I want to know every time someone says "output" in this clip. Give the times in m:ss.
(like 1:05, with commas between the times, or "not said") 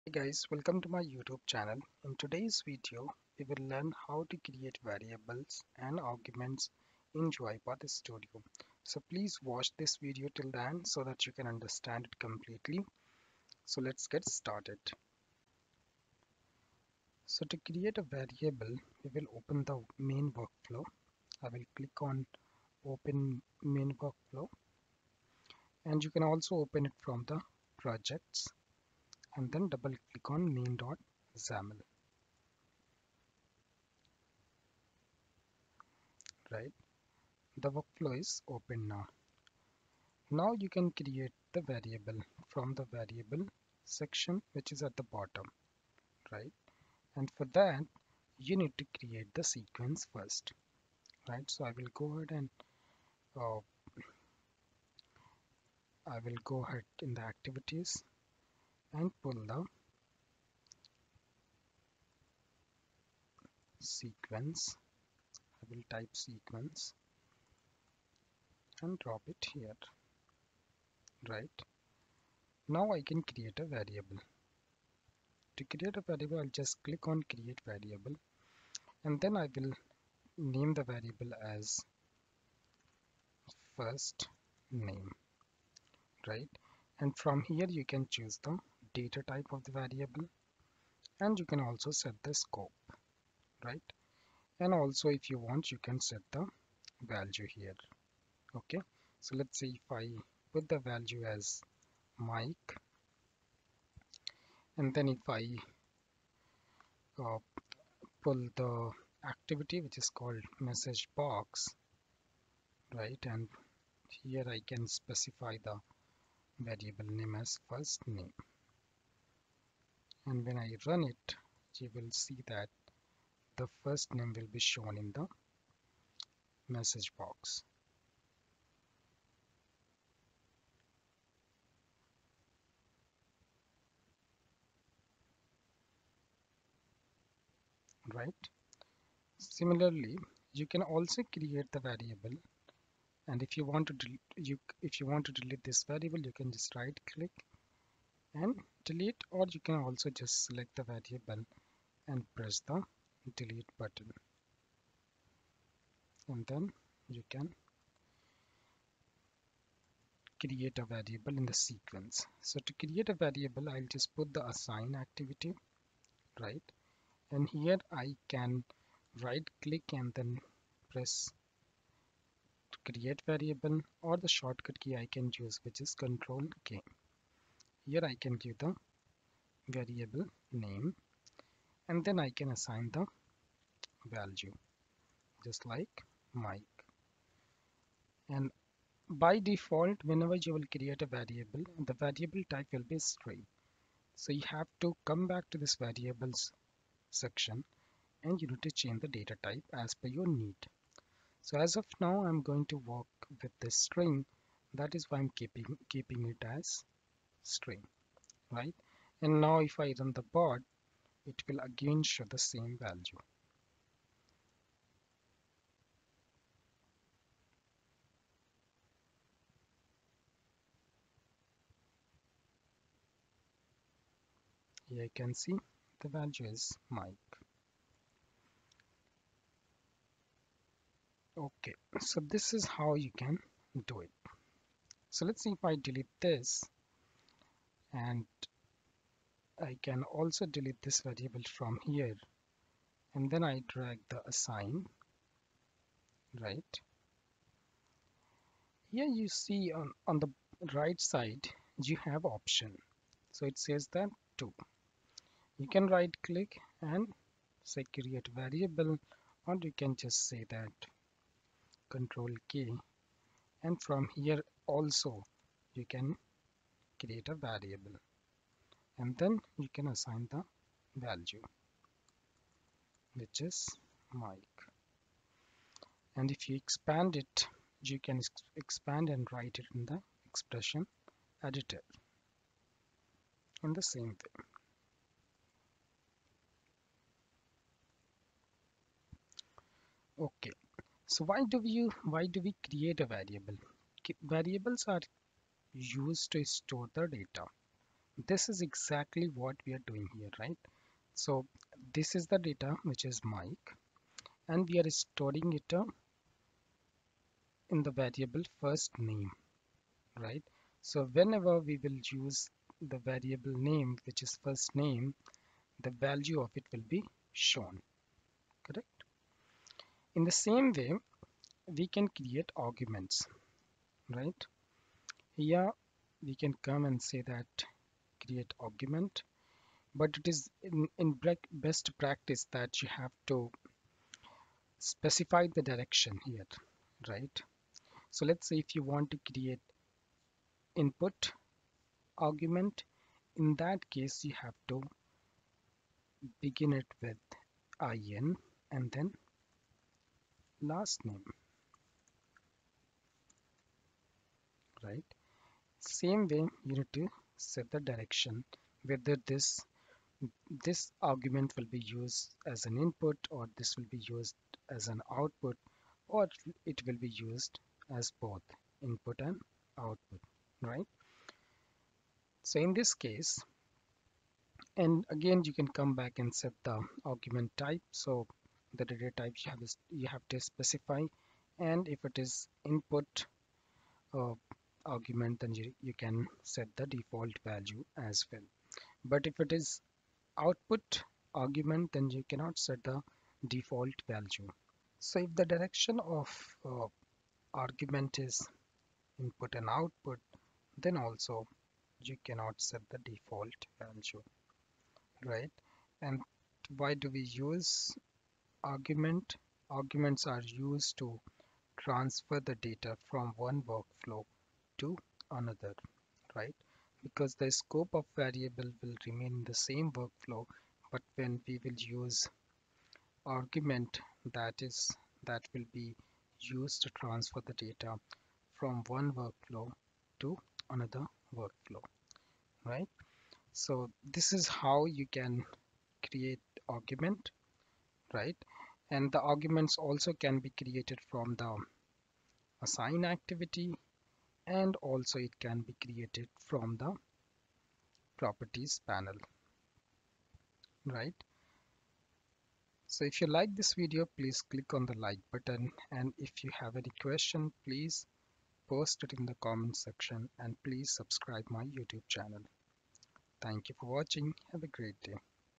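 6:05, 6:09, 6:30, 6:39.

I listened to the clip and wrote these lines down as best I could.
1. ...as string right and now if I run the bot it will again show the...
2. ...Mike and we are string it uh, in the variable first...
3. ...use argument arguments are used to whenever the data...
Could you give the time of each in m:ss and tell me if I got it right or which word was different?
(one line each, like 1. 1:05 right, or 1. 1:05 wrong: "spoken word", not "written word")
1. 3:26 right
2. 5:03 wrong: "storing", not "string"
3. 6:47 wrong: "transfer", not "whenever".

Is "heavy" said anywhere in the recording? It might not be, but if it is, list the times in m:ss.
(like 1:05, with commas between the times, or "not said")
not said.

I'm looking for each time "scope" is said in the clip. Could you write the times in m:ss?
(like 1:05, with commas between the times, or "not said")
1:32, 6:57.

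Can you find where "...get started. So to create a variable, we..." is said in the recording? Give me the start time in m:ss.
0:14.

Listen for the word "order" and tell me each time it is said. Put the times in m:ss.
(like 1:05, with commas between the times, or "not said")
not said.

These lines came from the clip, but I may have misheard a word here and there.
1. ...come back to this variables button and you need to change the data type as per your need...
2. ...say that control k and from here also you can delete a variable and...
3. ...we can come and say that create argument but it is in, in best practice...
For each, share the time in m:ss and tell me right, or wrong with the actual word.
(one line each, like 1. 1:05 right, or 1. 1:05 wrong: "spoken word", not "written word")
1. 3:15 wrong: "section", not "button"
2. 4:20 wrong: "create", not "delete"
3. 5:26 right.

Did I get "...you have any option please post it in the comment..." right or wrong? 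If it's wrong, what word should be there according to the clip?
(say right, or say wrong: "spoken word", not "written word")
wrong: "question", not "option".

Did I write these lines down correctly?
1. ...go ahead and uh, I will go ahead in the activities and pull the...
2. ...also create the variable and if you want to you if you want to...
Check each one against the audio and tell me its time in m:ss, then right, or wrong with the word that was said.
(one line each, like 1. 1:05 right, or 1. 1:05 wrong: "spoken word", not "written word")
1. 0:51 right
2. 2:20 right.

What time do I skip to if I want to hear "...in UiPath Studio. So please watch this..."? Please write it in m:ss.
0:07.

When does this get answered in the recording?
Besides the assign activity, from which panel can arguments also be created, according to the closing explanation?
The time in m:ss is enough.
7:28.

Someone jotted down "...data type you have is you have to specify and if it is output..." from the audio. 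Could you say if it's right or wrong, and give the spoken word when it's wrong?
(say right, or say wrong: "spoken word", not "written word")
wrong: "input", not "output".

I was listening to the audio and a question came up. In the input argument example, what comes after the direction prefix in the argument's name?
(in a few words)
last name.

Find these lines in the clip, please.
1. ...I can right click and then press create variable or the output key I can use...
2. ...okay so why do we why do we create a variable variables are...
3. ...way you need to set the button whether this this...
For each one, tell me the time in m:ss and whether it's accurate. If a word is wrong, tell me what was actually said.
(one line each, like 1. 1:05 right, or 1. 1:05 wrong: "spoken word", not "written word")
1. 2:47 wrong: "shortcut", not "output"
2. 4:50 right
3. 5:56 wrong: "direction", not "button".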